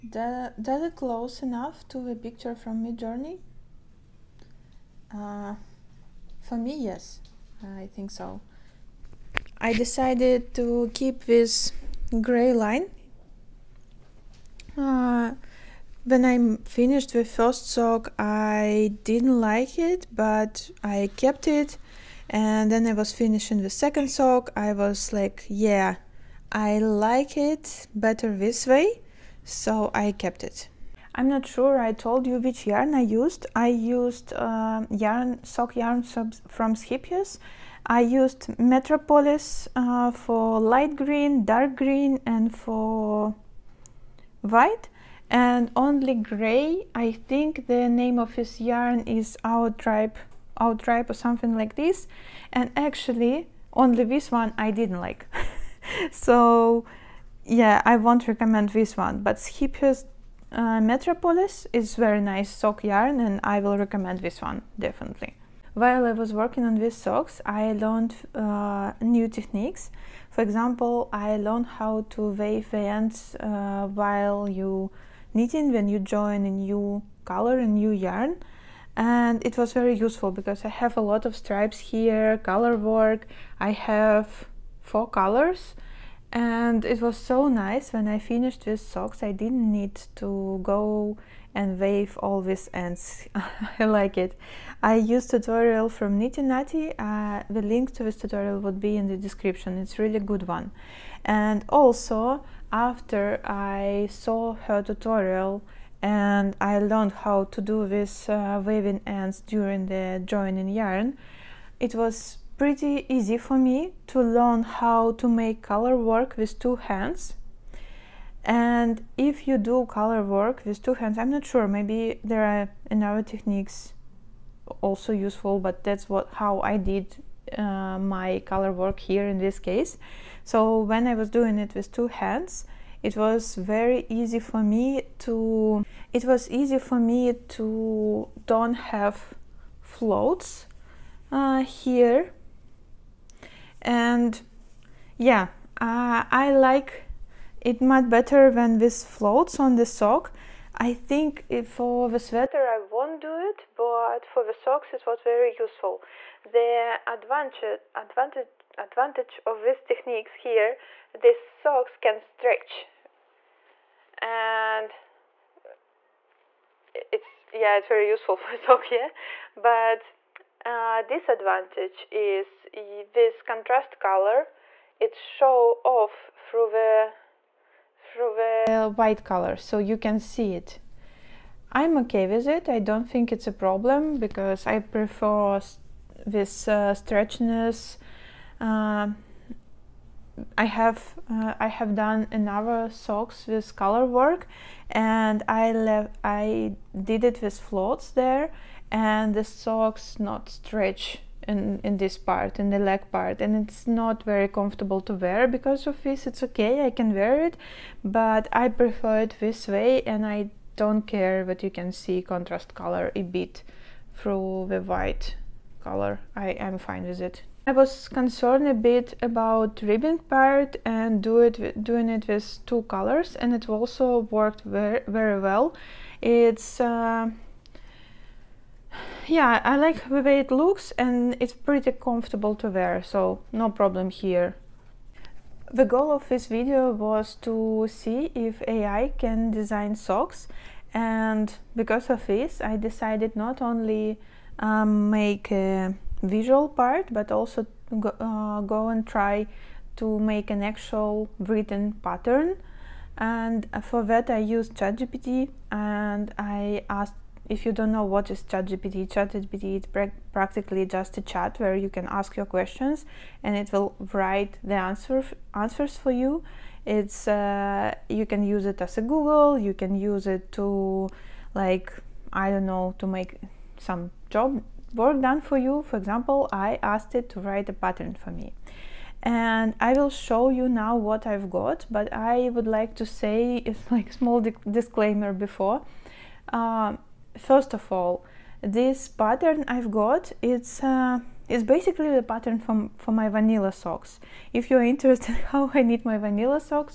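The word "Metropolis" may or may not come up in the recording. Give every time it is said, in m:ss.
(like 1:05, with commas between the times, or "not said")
0:38, 1:00.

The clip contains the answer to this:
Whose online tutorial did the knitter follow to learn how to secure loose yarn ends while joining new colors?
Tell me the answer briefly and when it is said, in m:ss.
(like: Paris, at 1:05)
Knitty Natty, at 1:36.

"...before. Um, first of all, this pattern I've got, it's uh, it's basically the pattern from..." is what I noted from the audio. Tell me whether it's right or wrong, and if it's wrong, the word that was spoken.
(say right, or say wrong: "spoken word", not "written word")
right.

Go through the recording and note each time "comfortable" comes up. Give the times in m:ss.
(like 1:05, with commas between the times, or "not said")
3:24, 3:51.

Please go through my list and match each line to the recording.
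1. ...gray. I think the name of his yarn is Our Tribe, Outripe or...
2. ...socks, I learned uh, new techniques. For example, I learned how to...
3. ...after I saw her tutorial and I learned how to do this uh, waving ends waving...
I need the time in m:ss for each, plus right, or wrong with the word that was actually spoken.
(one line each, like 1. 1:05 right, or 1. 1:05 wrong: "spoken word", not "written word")
1. 0:46 right
2. 1:06 right
3. 1:42 wrong: "during", not "waving".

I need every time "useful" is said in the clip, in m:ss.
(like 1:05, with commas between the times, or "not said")
1:19, 2:05, 2:35, 2:48.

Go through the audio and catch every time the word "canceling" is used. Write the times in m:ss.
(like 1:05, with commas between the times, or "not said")
not said.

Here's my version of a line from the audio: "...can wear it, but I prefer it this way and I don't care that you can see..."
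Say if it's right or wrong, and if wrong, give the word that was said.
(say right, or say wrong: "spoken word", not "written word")
right.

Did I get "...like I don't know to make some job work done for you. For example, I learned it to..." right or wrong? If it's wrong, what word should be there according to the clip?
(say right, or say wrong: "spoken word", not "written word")
wrong: "asked", not "learned".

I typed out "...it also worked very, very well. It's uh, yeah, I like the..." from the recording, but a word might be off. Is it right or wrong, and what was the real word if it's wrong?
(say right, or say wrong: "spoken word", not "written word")
right.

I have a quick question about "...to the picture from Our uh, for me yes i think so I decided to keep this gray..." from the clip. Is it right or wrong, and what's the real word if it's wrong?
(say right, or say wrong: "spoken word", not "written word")
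wrong: "Midjourney", not "Our".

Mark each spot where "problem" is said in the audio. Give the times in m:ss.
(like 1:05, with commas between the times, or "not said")
3:03, 3:53.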